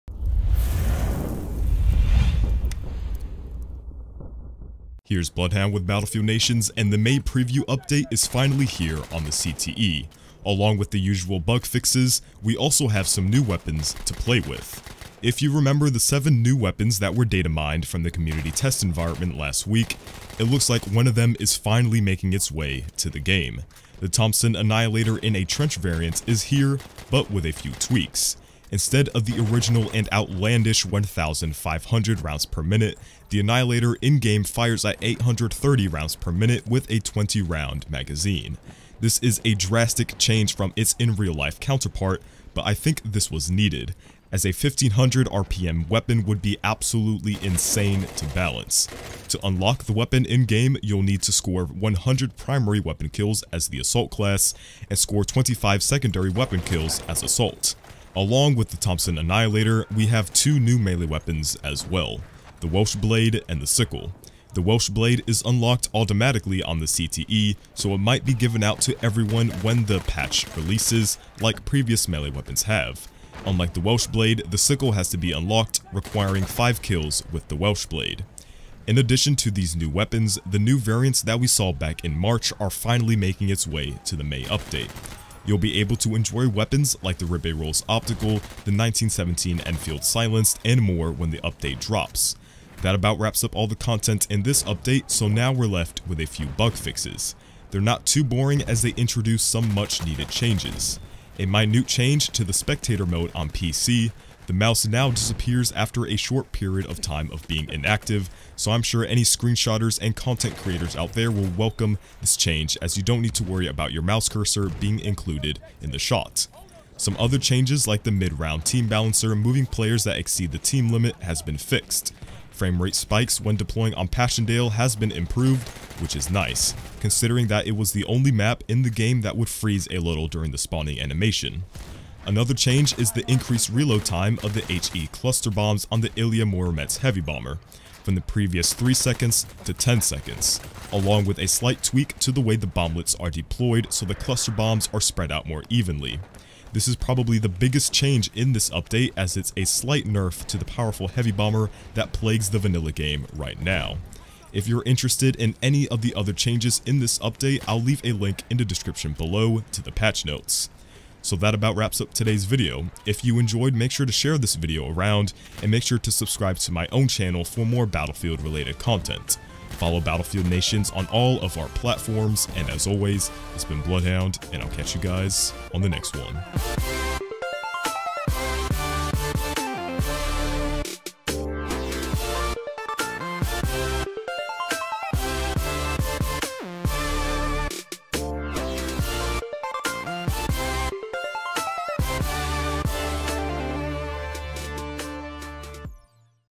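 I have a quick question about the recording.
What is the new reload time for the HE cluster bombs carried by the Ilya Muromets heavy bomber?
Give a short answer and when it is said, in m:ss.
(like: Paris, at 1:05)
10 seconds, at 2:19.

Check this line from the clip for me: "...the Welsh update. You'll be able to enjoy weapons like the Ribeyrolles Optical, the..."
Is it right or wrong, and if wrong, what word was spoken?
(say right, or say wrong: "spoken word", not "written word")
wrong: "May", not "Welsh".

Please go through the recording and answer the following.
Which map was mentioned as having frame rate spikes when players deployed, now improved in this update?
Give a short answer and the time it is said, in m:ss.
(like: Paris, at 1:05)
Passchendaele, at 2:04.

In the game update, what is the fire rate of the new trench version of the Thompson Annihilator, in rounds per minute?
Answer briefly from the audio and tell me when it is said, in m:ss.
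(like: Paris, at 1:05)
830, at 0:35.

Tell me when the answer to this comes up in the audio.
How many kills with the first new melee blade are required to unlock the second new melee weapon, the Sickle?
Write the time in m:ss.
1:16.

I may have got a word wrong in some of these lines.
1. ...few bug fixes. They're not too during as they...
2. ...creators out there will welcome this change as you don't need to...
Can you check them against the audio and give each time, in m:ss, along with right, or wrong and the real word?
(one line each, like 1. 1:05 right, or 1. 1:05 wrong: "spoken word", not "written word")
1. 1:36 wrong: "boring", not "during"
2. 1:50 right.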